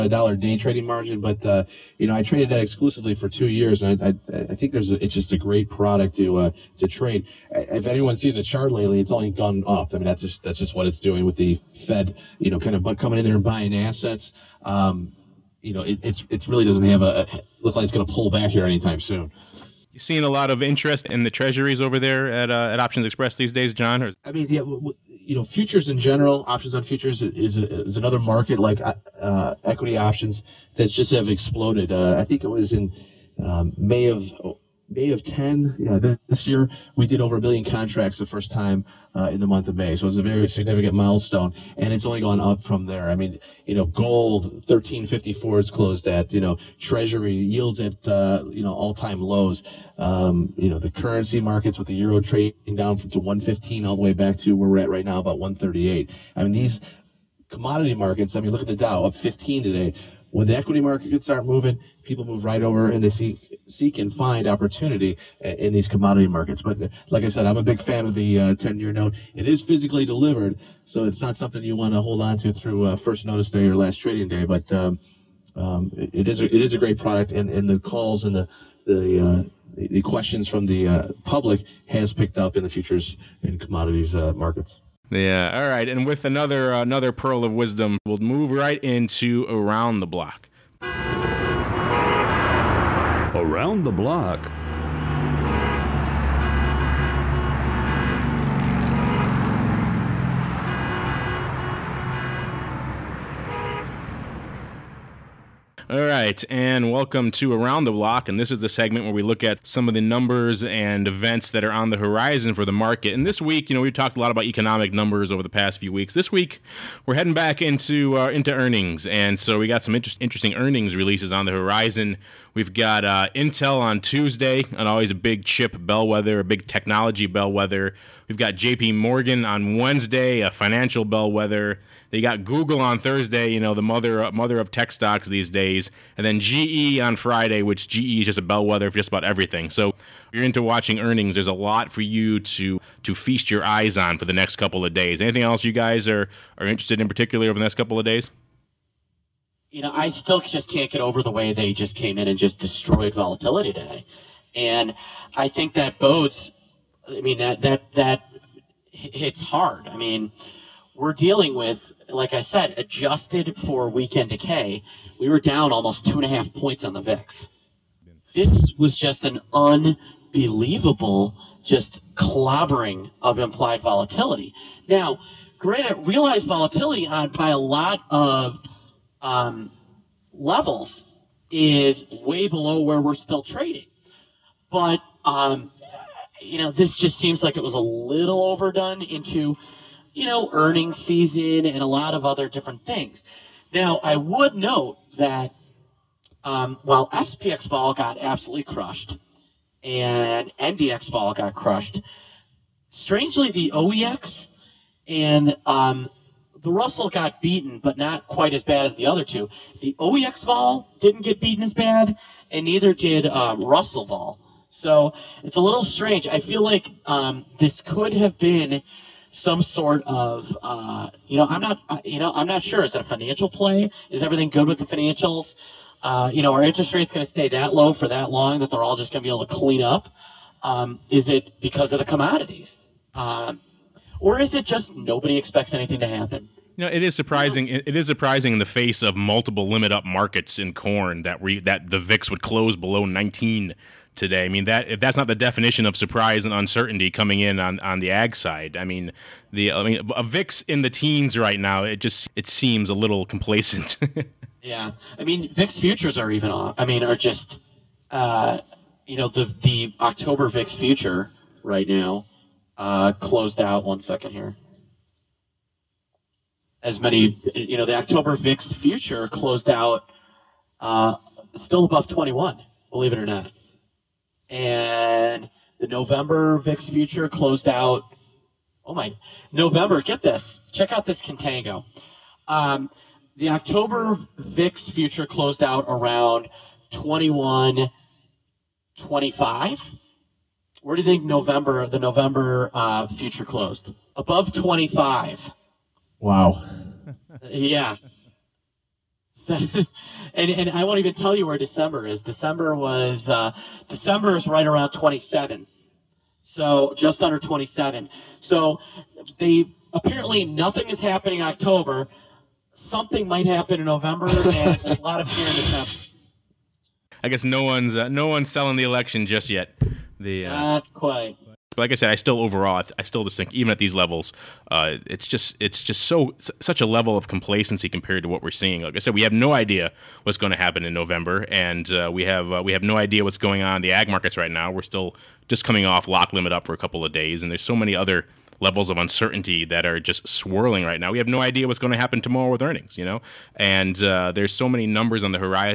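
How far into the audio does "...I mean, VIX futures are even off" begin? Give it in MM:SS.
04:15.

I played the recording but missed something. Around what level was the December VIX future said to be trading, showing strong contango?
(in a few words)
27.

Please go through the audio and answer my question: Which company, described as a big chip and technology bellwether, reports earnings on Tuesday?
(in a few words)
Intel.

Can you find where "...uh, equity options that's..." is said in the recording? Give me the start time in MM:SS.
00:29.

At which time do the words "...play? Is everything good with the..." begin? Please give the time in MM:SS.
03:43.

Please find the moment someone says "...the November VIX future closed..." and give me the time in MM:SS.
04:35.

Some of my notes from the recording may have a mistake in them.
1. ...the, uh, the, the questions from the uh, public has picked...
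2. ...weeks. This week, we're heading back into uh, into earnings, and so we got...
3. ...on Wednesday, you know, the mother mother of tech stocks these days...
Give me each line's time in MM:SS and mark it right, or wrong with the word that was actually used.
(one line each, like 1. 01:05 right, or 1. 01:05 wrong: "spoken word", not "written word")
1. 01:18 right
2. 01:55 right
3. 02:12 wrong: "Thursday", not "Wednesday".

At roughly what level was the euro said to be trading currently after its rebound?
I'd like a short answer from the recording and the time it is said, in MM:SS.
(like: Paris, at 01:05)
138, at 00:55.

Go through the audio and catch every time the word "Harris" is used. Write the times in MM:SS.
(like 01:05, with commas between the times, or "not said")
not said.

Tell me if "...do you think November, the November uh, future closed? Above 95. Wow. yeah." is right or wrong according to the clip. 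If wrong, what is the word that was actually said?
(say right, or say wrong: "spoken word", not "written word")
wrong: "25", not "95".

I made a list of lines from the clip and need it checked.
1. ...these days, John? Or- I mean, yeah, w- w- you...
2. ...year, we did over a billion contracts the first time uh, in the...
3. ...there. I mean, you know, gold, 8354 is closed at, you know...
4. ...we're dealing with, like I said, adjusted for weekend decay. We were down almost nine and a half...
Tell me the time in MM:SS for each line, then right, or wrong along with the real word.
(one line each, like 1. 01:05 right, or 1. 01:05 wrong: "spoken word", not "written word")
1. 00:23 right
2. 00:36 right
3. 00:42 wrong: "1354", not "8354"
4. 02:40 wrong: "two", not "nine".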